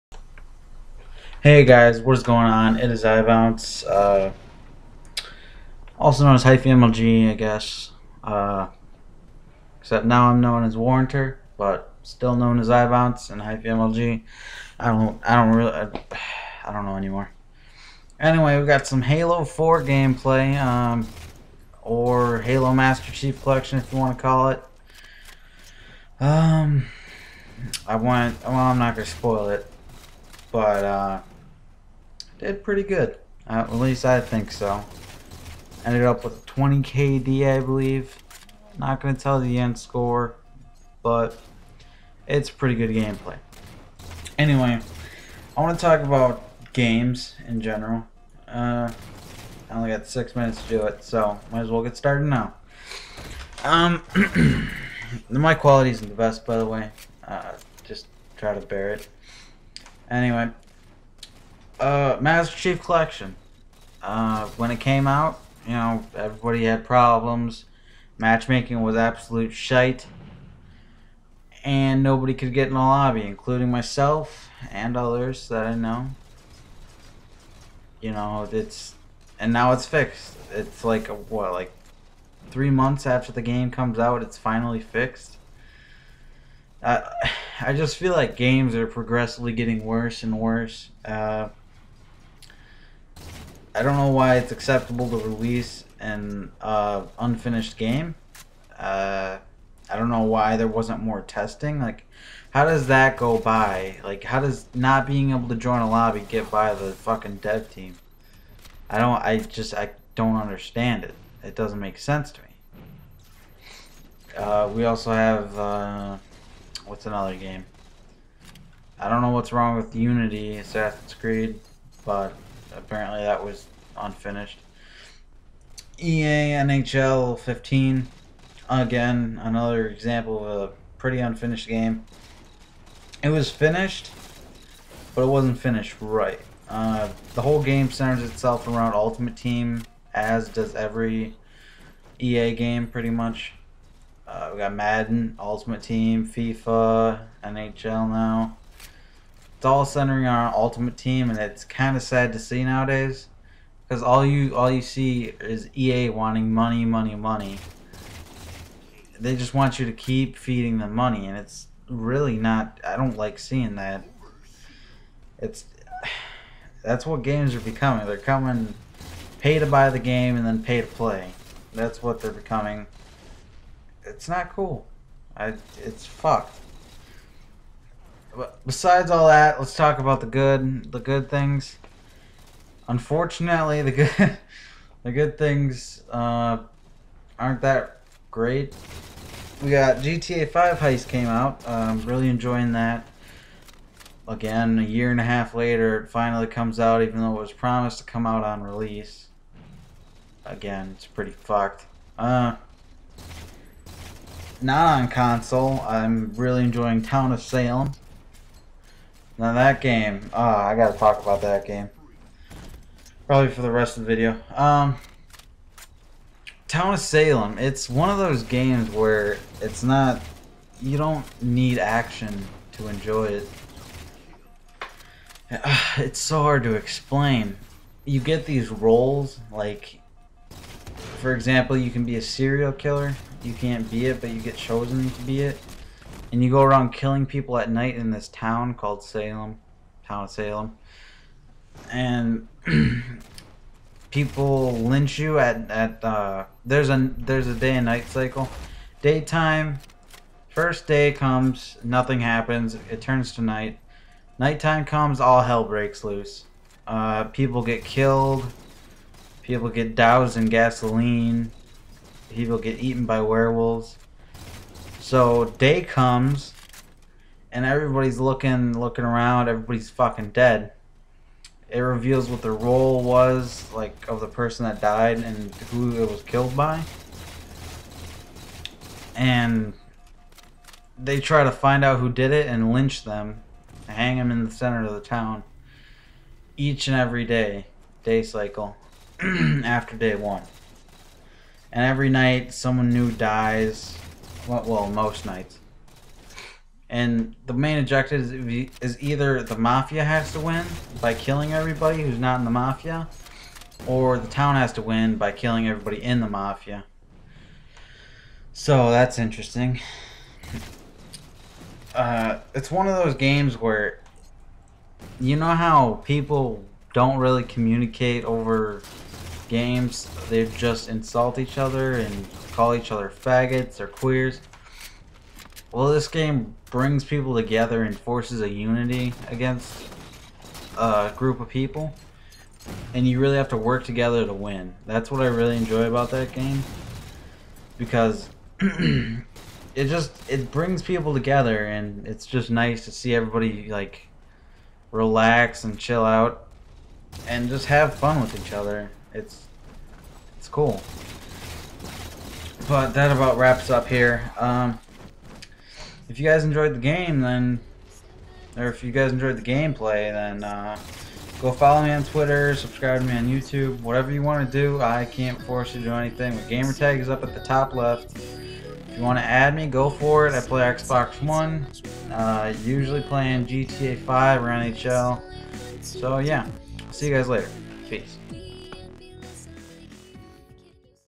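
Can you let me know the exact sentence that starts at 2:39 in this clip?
They just want you to keep feeding them money, and it's really not.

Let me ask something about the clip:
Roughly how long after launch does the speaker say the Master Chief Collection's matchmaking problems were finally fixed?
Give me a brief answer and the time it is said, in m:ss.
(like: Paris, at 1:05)
three months, at 1:22.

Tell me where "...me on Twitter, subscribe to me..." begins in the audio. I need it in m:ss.
6:01.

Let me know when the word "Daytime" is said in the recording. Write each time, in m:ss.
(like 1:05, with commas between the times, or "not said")
4:09.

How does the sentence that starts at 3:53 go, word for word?
You can't be it, but you get chosen to be it.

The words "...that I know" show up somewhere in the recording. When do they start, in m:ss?
1:15.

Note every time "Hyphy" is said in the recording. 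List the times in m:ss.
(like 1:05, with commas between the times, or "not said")
0:06, 0:13.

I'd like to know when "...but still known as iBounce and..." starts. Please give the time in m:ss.
0:11.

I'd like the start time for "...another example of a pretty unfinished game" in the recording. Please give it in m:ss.
2:09.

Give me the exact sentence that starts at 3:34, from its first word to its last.
Um, Town of Salem, it's one of those games where it's not, you don't need action to enjoy it.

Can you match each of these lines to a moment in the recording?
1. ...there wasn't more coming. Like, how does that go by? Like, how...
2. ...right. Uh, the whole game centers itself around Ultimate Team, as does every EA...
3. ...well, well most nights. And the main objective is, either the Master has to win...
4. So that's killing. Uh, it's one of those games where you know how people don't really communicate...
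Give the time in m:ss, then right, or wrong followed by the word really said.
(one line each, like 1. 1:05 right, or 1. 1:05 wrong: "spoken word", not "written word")
1. 1:40 wrong: "testing", not "coming"
2. 2:16 right
3. 4:54 wrong: "Mafia", not "Master"
4. 5:08 wrong: "interesting", not "killing".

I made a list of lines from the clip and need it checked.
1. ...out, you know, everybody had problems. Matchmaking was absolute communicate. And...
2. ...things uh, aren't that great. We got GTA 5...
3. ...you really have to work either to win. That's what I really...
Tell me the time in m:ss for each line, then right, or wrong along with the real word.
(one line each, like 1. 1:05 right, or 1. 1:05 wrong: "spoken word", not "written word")
1. 1:05 wrong: "shite", not "communicate"
2. 3:05 right
3. 5:33 wrong: "together", not "either".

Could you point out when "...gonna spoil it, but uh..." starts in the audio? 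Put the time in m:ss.
0:28.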